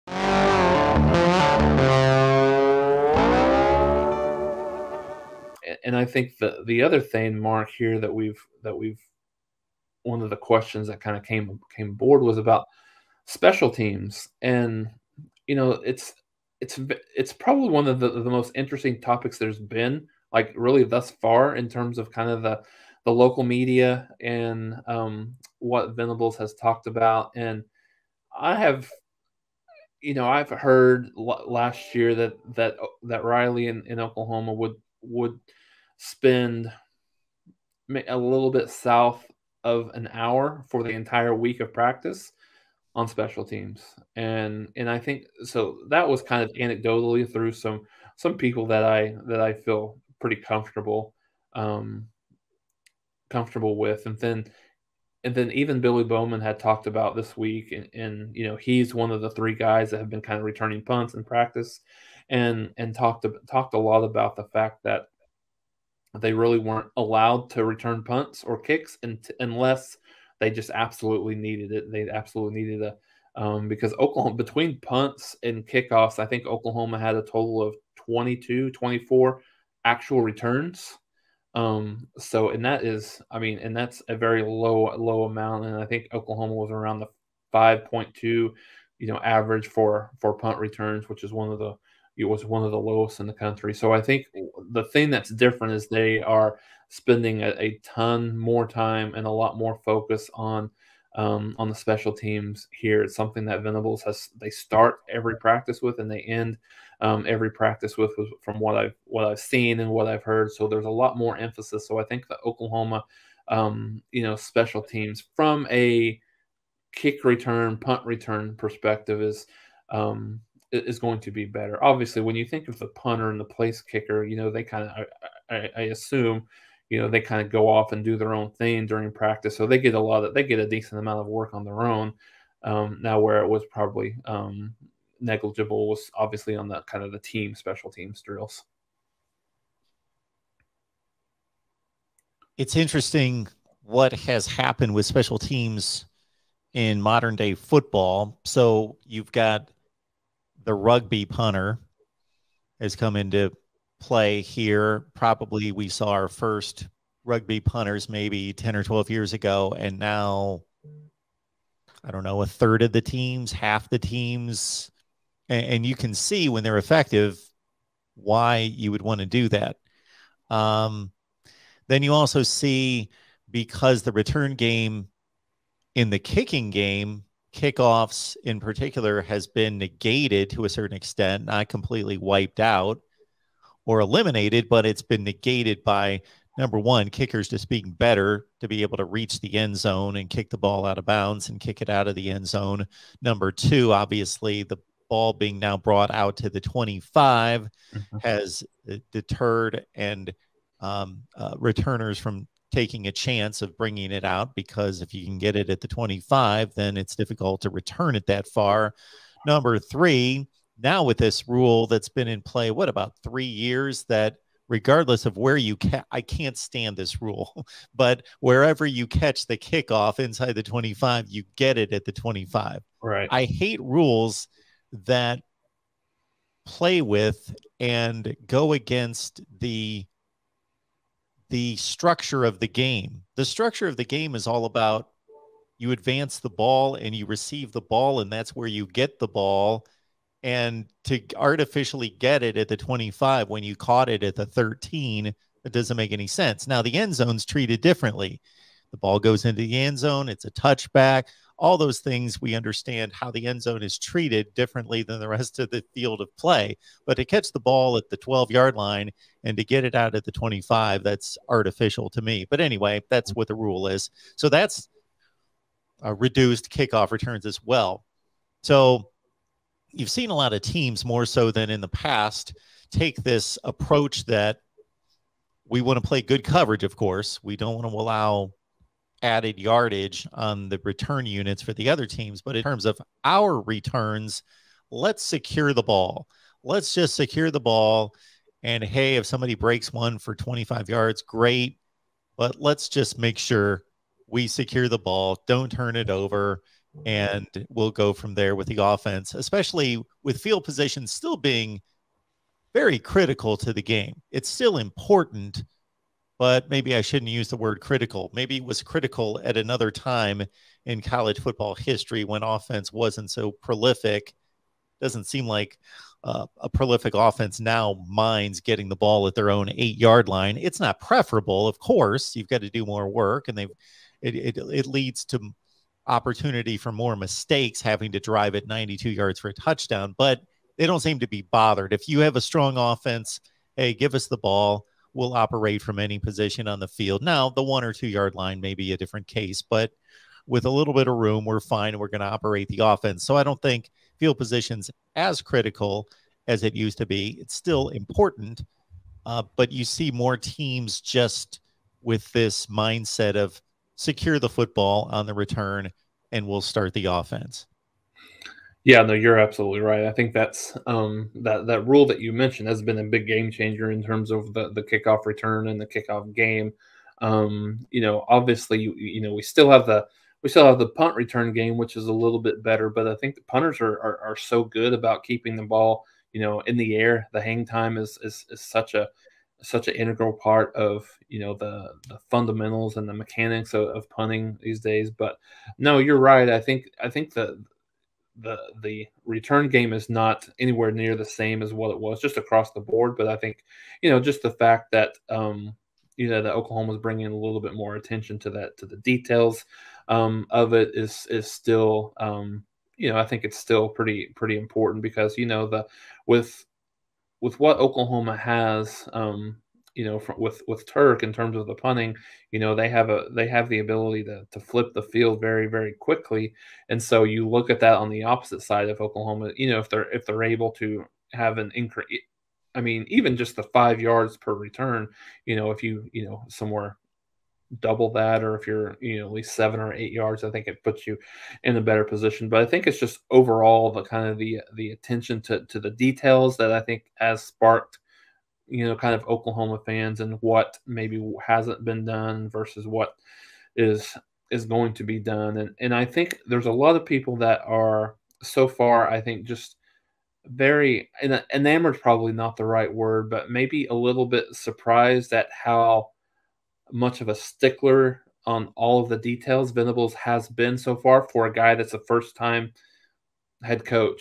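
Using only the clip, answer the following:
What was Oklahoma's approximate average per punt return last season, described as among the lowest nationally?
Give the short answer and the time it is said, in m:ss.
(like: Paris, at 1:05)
5.2, at 1:27.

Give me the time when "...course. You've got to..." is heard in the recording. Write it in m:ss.
5:21.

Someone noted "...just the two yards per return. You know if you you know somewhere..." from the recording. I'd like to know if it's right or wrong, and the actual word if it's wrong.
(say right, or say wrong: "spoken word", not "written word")
wrong: "five", not "two".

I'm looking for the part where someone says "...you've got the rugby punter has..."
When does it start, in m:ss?
2:29.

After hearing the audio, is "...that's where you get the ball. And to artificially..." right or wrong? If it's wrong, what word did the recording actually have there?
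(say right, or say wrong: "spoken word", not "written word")
right.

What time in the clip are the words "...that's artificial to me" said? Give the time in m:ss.
4:21.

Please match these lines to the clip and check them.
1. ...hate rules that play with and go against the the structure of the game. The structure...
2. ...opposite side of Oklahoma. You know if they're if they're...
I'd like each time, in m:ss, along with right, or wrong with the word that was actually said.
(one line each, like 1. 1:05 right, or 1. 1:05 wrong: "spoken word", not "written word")
1. 3:43 right
2. 6:58 right.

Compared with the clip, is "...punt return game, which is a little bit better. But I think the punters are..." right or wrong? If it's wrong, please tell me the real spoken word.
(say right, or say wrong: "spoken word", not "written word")
right.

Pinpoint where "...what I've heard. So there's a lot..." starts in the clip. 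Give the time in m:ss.
1:49.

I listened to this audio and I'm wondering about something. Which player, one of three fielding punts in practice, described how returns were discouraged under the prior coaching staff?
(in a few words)
Billy Bowman.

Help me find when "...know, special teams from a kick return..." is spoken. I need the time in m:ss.
1:54.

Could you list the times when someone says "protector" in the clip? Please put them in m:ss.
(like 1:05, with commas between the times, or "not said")
not said.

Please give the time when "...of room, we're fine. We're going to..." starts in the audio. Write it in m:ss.
5:41.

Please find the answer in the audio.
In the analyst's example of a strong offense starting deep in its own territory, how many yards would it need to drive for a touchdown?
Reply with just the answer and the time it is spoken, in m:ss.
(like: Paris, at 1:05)
92, at 5:28.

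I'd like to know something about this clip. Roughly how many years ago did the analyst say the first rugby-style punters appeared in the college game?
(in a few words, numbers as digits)
10 or 12 years.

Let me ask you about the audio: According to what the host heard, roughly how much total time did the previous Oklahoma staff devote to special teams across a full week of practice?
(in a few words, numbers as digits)
a little bit south of an hour.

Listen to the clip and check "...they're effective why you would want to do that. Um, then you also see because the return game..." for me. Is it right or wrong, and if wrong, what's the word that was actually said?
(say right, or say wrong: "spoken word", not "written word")
right.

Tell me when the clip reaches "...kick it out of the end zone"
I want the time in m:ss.
3:11.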